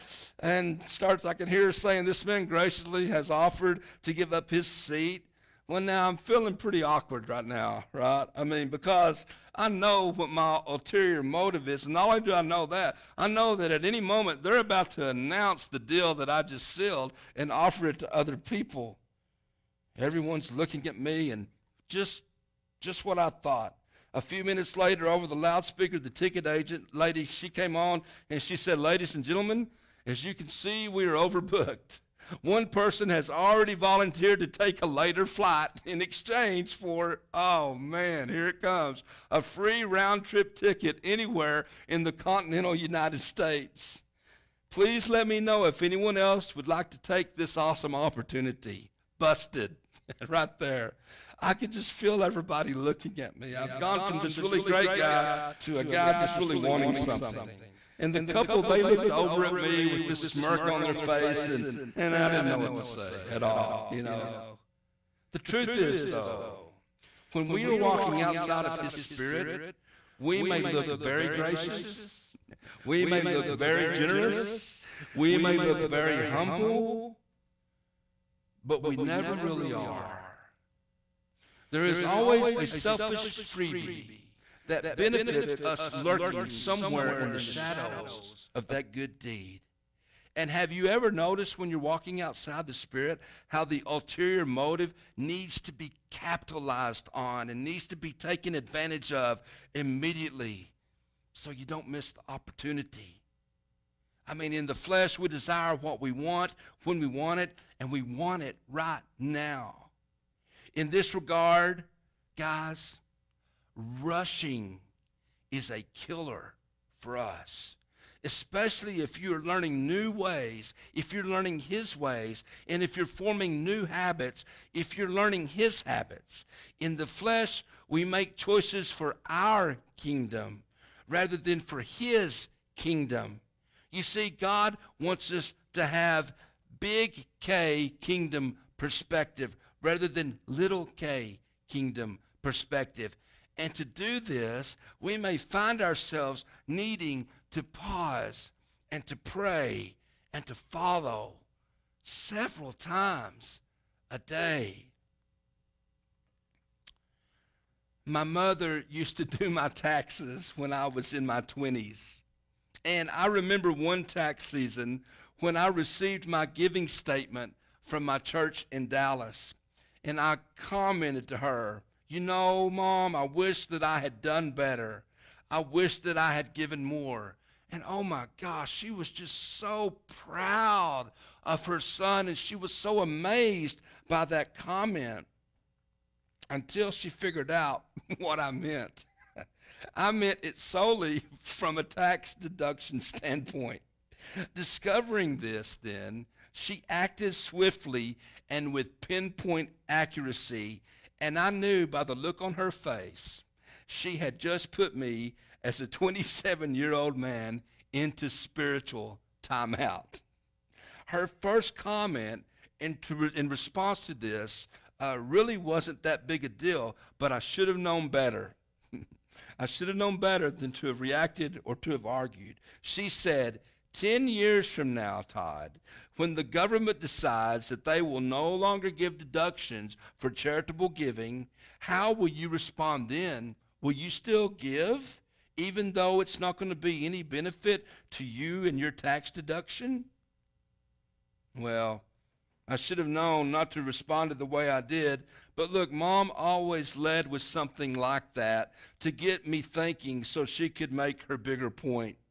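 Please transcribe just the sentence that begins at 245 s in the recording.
But look, mom always led with something like that to get me thinking so she could make her bigger point.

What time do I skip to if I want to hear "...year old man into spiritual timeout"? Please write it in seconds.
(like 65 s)
206 s.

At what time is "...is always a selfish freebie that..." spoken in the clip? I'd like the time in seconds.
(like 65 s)
81 s.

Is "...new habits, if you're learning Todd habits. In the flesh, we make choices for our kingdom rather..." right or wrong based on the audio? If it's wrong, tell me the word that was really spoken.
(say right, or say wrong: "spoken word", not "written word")
wrong: "His", not "Todd".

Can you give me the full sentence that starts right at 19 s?
Everyone's looking at me, and just, just what I thought.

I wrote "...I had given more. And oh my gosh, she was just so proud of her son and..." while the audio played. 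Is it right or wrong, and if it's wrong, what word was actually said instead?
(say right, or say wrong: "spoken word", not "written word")
right.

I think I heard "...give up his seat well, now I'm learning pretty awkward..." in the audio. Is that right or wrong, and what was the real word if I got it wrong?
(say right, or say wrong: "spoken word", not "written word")
wrong: "feeling", not "learning".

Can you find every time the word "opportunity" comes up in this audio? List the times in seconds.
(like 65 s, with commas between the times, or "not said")
47 s, 102 s.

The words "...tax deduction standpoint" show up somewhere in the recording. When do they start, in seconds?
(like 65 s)
191 s.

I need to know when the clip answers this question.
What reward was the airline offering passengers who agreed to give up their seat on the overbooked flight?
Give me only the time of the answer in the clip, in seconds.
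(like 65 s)
39 s.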